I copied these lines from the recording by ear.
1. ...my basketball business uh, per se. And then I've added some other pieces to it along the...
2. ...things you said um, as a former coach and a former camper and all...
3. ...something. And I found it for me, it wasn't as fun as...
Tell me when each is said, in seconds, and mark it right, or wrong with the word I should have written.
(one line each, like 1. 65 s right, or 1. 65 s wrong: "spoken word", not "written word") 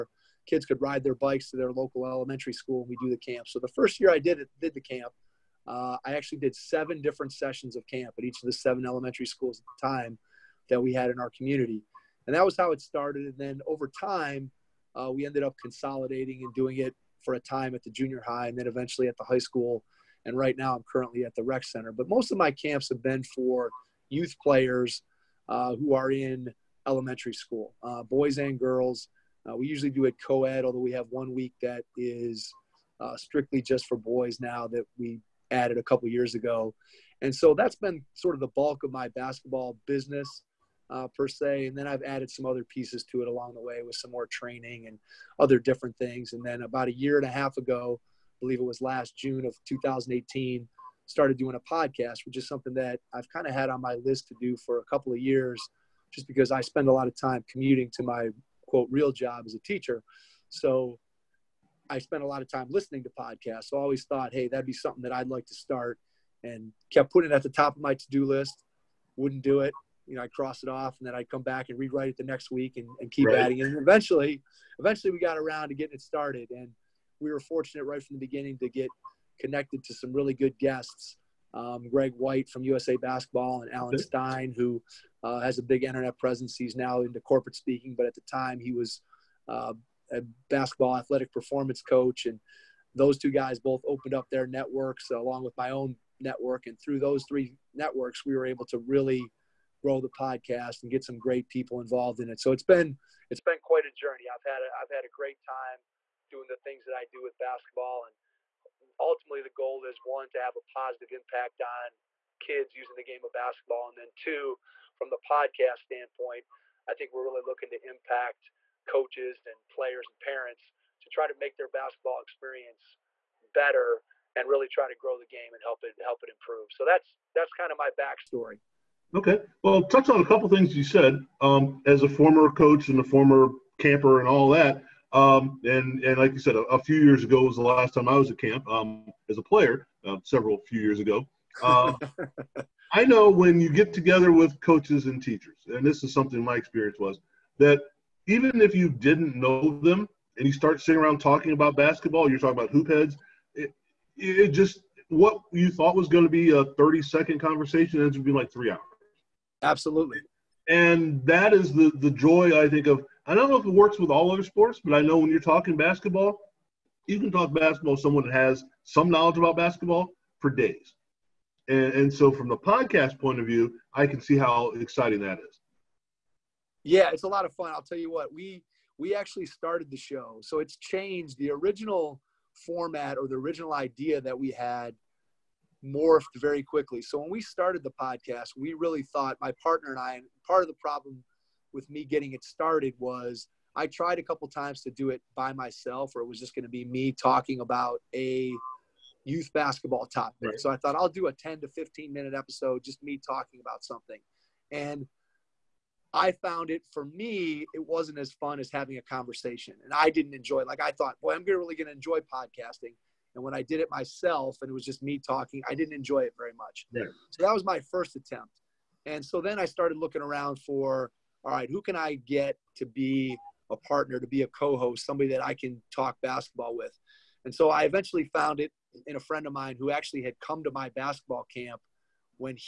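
1. 38 s right
2. 130 s right
3. 203 s right.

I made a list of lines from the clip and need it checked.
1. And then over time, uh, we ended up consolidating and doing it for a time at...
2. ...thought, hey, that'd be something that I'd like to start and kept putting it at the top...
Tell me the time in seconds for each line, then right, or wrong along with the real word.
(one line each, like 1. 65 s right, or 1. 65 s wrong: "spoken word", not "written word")
1. 13 s right
2. 64 s right.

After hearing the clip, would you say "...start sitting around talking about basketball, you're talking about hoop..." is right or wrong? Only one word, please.
right.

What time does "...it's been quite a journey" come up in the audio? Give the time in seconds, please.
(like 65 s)
103 s.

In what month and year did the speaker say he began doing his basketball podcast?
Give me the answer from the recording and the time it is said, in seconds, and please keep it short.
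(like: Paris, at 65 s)
June 2018, at 49 s.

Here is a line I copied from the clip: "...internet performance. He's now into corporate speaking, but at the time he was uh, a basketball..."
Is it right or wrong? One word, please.
wrong.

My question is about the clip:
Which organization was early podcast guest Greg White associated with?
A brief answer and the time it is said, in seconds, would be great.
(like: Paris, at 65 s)
USA Basketball, at 82 s.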